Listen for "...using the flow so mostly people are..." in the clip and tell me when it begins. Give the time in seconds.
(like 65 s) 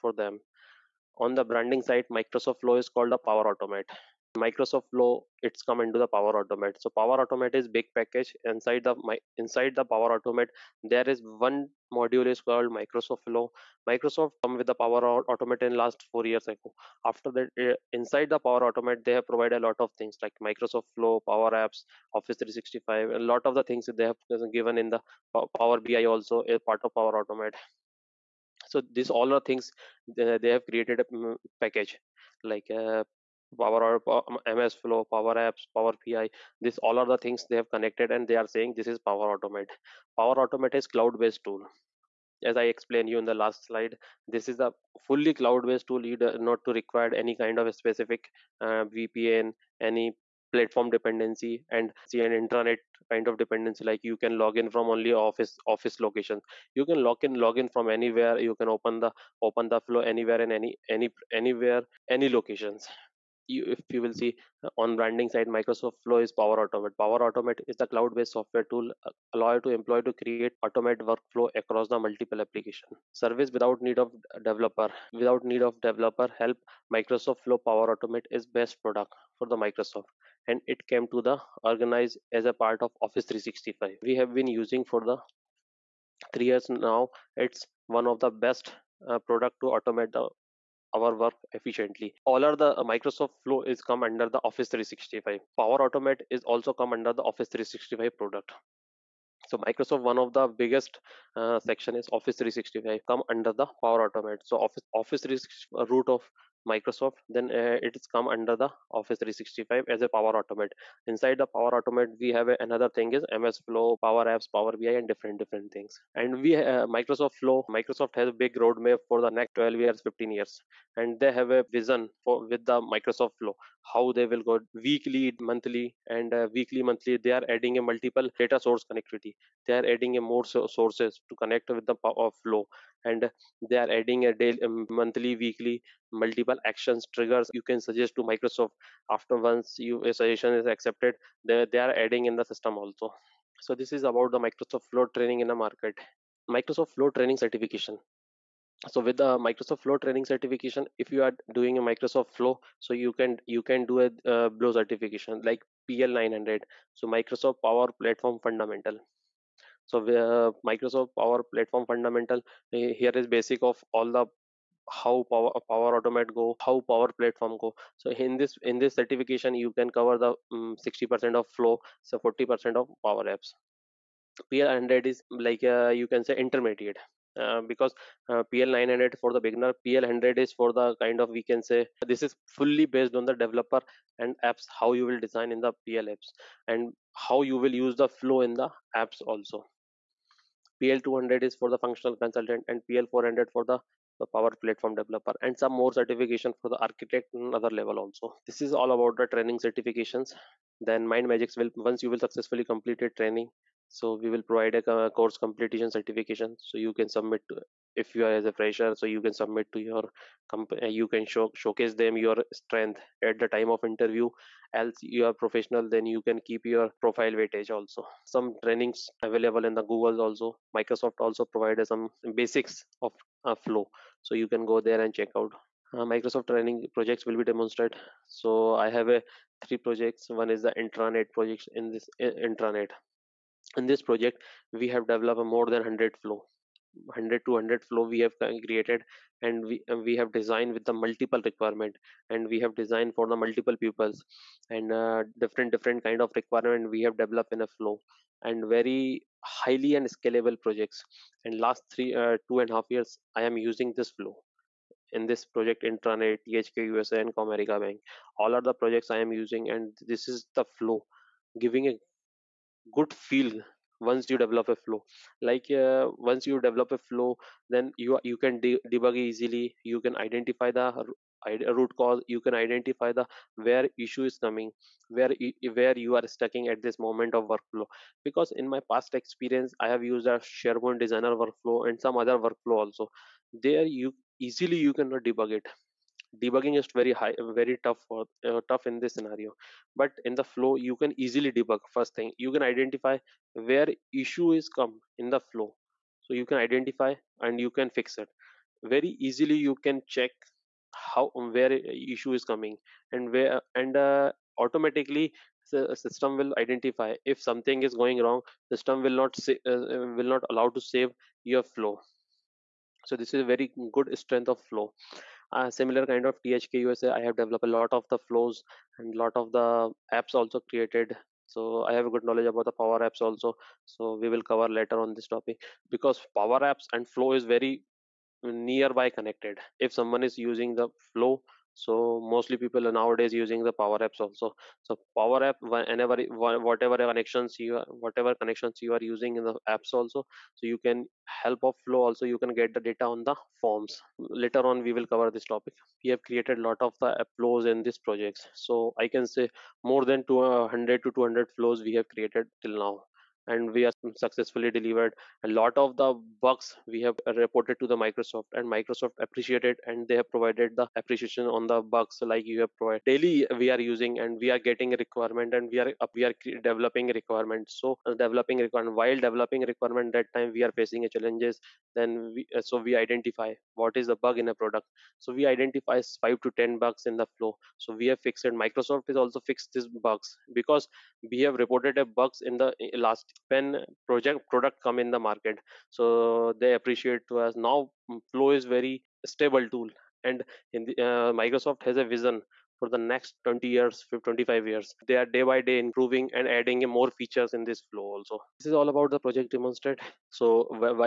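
330 s.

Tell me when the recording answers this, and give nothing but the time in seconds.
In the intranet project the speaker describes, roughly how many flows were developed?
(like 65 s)
235 s.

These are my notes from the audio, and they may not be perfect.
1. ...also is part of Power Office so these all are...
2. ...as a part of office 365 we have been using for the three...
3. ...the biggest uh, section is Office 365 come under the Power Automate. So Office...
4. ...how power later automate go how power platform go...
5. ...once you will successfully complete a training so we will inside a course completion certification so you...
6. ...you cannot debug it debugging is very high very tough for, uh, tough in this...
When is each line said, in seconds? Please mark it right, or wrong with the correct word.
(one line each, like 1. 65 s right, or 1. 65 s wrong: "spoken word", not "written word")
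1. 26 s wrong: "Automate", not "Office"
2. 82 s right
3. 100 s right
4. 164 s wrong: "power", not "later"
5. 201 s wrong: "provide", not "inside"
6. 284 s right.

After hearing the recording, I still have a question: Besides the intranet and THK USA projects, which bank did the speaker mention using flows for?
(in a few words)
Comerica Bank.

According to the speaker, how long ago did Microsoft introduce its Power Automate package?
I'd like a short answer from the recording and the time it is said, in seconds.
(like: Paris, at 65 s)
4 years ago, at 16 s.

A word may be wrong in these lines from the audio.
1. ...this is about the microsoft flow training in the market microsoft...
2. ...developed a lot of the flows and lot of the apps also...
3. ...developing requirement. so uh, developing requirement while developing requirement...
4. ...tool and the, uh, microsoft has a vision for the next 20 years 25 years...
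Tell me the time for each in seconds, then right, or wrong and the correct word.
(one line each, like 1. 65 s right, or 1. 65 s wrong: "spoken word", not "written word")
1. 143 s right
2. 317 s right
3. 366 s right
4. 389 s right.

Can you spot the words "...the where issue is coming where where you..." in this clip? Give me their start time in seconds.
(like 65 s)
273 s.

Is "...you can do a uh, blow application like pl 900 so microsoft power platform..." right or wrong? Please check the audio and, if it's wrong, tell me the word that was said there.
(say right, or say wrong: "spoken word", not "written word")
wrong: "certification", not "application".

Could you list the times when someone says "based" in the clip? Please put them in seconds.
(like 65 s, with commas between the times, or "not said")
41 s, 45 s, 68 s, 182 s.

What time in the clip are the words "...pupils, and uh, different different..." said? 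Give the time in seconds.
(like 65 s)
243 s.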